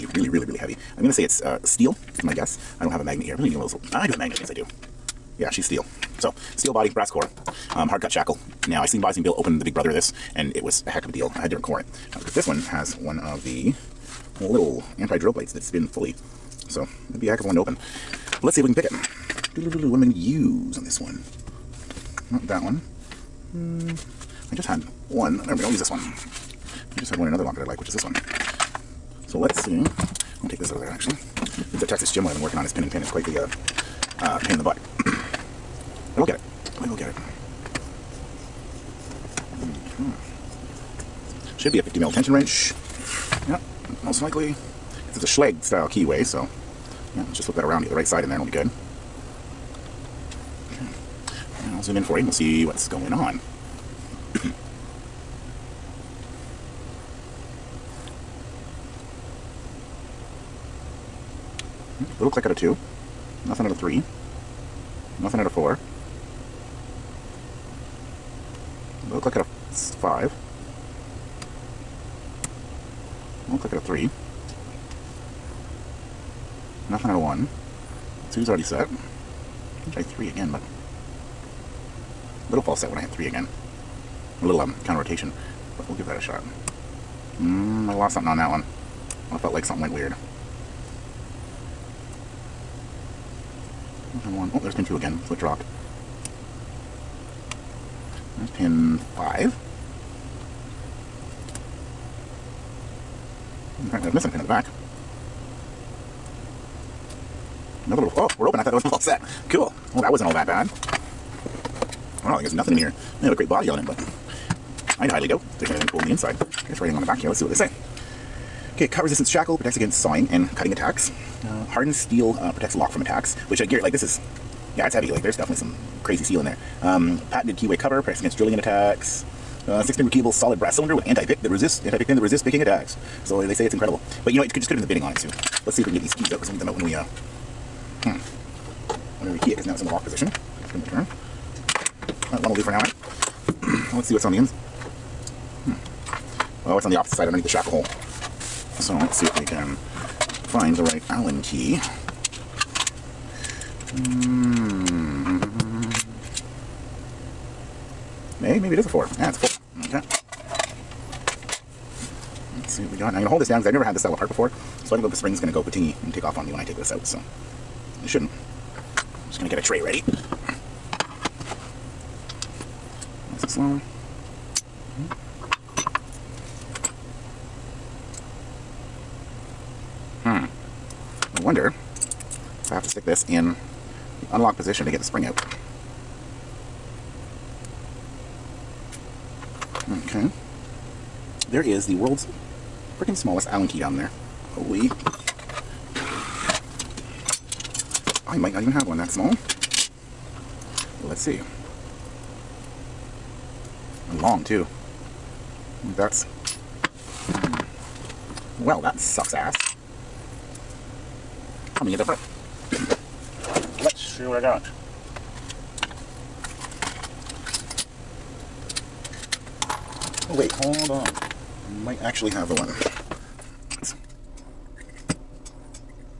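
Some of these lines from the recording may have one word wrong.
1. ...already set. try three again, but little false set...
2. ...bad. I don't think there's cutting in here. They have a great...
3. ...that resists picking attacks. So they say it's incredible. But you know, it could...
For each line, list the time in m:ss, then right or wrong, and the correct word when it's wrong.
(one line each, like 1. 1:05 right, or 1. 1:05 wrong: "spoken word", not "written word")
1. 1:18 right
2. 1:50 wrong: "nothing", not "cutting"
3. 2:12 right.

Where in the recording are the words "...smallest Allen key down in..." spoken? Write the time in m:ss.
3:13.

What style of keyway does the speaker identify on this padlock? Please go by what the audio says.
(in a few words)
Schlage.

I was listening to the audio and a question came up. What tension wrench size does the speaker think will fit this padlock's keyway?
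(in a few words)
50 mil.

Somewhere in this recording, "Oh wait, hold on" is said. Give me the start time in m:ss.
3:40.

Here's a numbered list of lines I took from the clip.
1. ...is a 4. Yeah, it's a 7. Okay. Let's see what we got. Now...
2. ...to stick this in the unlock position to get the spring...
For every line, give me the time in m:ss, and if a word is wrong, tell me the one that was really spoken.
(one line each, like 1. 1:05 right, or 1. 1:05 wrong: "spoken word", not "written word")
1. 2:38 wrong: "4", not "7"
2. 3:02 right.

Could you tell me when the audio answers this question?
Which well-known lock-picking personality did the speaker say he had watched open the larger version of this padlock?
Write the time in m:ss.
0:09.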